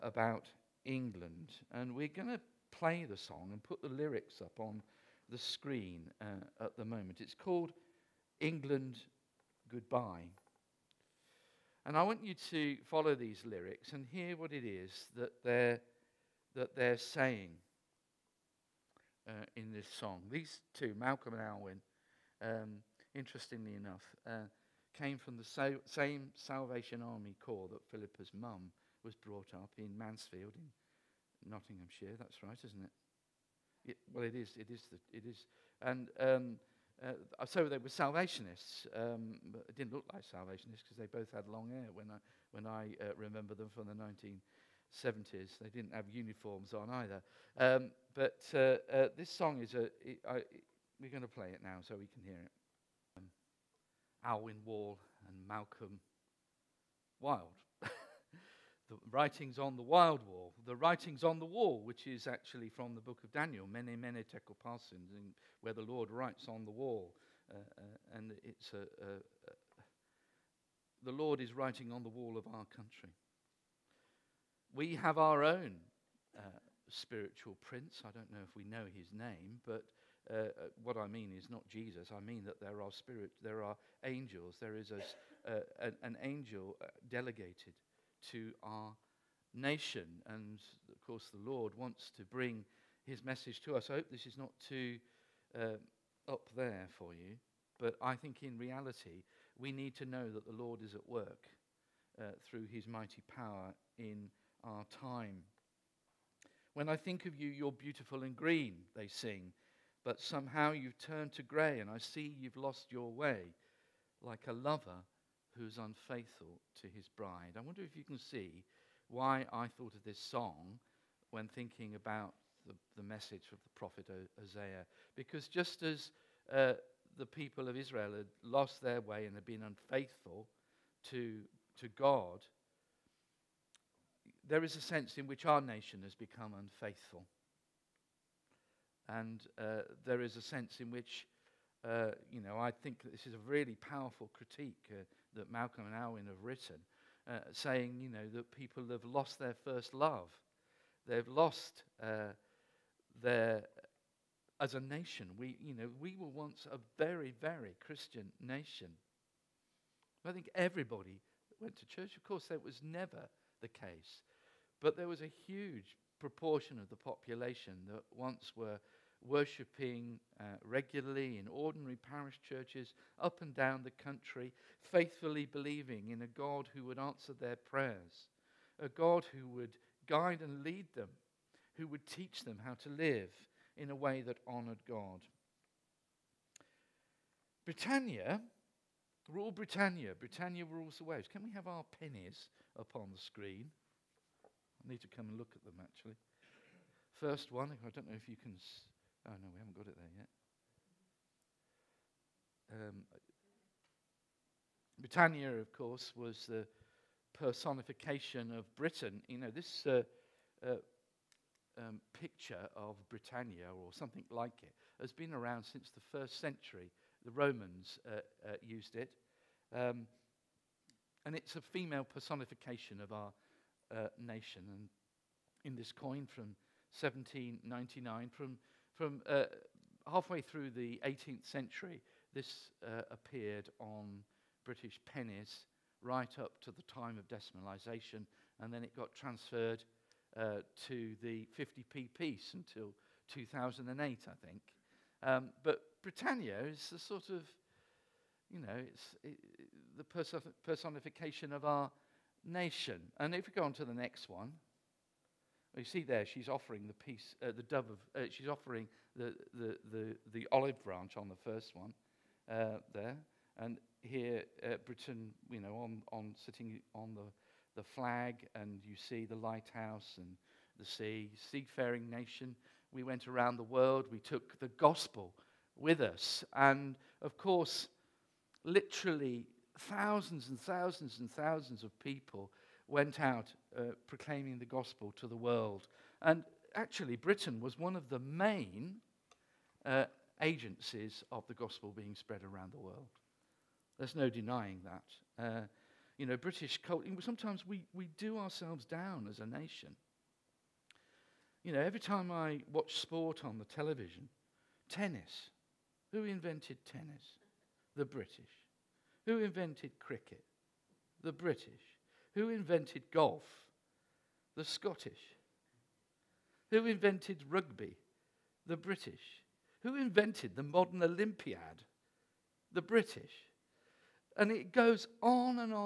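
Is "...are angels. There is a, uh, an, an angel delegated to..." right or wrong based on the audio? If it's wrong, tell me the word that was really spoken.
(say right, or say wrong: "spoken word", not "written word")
right.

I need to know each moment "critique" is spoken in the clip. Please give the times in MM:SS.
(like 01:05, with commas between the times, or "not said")
02:24.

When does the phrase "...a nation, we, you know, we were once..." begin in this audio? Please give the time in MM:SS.
02:34.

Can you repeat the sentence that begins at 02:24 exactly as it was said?
Uh, that Malcolm and Alwyn have written, uh, saying, you know, that people have lost their first love.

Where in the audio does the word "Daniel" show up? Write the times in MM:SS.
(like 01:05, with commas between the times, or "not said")
01:03.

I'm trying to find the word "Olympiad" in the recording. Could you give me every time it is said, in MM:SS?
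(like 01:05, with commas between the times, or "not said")
05:21.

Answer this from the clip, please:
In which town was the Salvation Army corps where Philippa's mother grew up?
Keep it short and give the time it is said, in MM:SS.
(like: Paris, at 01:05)
Mansfield, at 00:29.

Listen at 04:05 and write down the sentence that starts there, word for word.
Um, but Britannia is the sort of, you know, it's it, the personification of our nation.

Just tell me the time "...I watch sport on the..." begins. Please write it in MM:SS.
05:02.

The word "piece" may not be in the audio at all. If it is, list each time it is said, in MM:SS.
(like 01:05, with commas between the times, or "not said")
04:02, 04:16.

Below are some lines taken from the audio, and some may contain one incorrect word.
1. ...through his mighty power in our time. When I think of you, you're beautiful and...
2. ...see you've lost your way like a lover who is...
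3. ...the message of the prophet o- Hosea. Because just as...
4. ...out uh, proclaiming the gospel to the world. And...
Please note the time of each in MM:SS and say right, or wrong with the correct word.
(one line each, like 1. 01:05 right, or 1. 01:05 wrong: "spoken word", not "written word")
1. 01:42 right
2. 01:51 right
3. 02:02 right
4. 04:43 right.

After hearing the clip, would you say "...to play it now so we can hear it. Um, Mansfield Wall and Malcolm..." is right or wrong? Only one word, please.
wrong.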